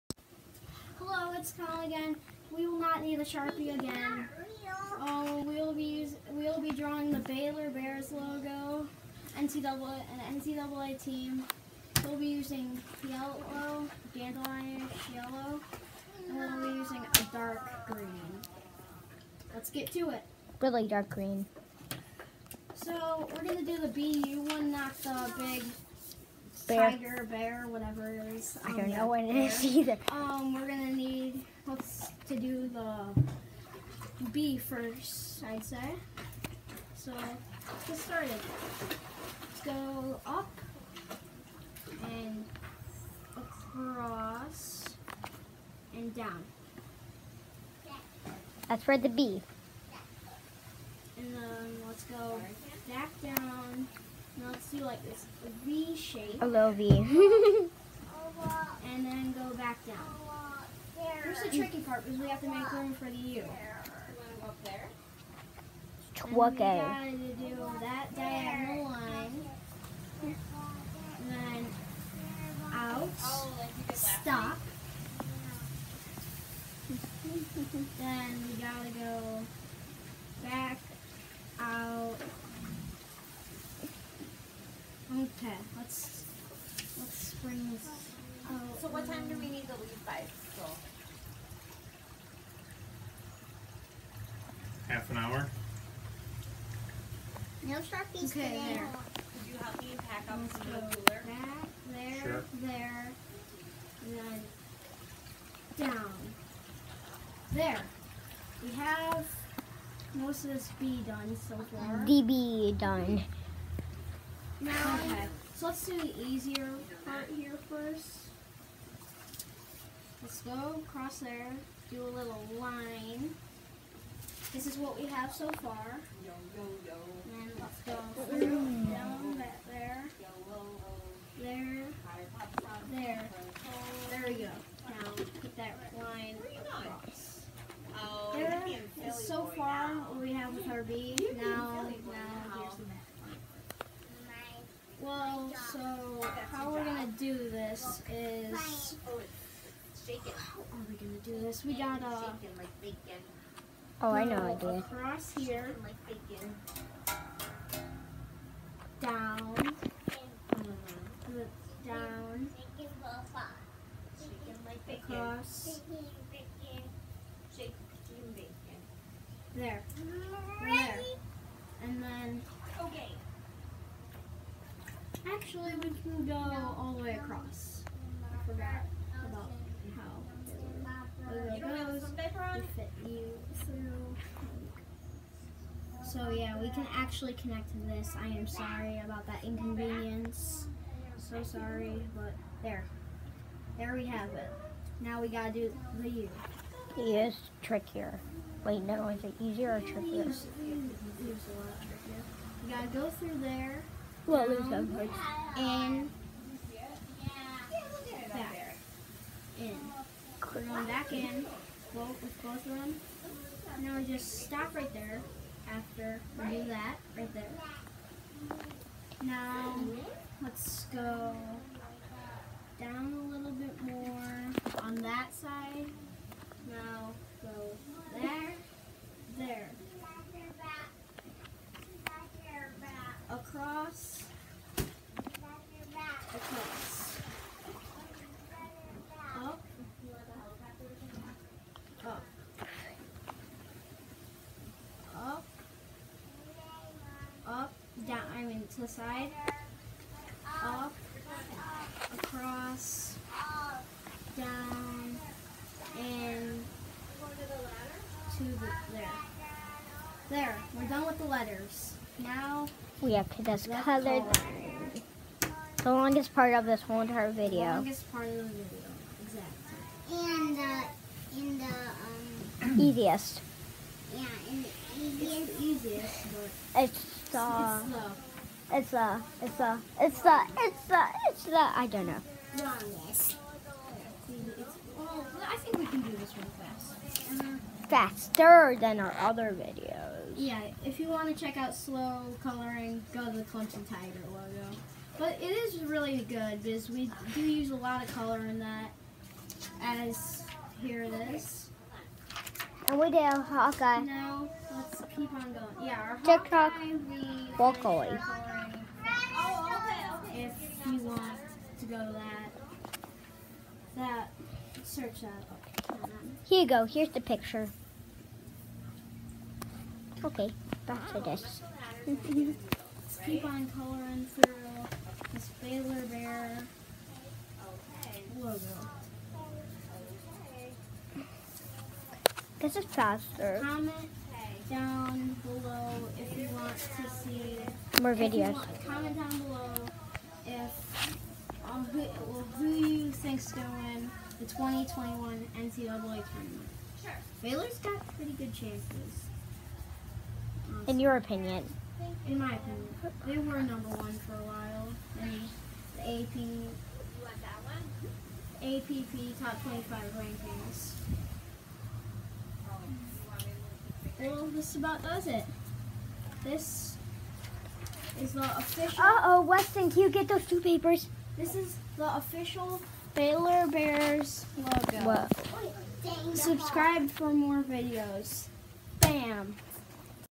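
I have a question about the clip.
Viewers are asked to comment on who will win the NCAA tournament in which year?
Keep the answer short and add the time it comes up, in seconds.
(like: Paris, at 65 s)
2021, at 344 s.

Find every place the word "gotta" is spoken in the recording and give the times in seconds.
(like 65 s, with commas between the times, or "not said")
66 s, 78 s, 195 s, 202 s.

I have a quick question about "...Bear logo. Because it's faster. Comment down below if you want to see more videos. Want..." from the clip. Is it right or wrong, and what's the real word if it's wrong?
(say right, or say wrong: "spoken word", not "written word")
right.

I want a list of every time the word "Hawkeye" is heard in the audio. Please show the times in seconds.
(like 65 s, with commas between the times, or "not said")
303 s, 307 s.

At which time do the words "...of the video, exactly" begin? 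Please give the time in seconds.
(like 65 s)
268 s.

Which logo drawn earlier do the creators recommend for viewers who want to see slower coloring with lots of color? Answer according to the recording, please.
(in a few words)
Tiger logo.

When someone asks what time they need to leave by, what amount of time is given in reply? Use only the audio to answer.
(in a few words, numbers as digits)
Half an hour.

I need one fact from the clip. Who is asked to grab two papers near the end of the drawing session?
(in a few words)
Weston.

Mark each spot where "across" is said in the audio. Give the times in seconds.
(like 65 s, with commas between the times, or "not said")
43 s, 120 s, 177 s, 252 s.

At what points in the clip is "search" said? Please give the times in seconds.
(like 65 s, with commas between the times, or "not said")
314 s.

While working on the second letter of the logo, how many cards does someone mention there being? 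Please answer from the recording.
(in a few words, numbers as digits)
7.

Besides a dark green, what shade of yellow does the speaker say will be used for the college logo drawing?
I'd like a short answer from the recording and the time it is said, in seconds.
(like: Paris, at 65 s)
dandelionish yellow, at 14 s.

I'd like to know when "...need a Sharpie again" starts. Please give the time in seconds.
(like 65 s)
3 s.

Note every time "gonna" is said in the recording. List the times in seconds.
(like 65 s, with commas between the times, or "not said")
23 s, 30 s.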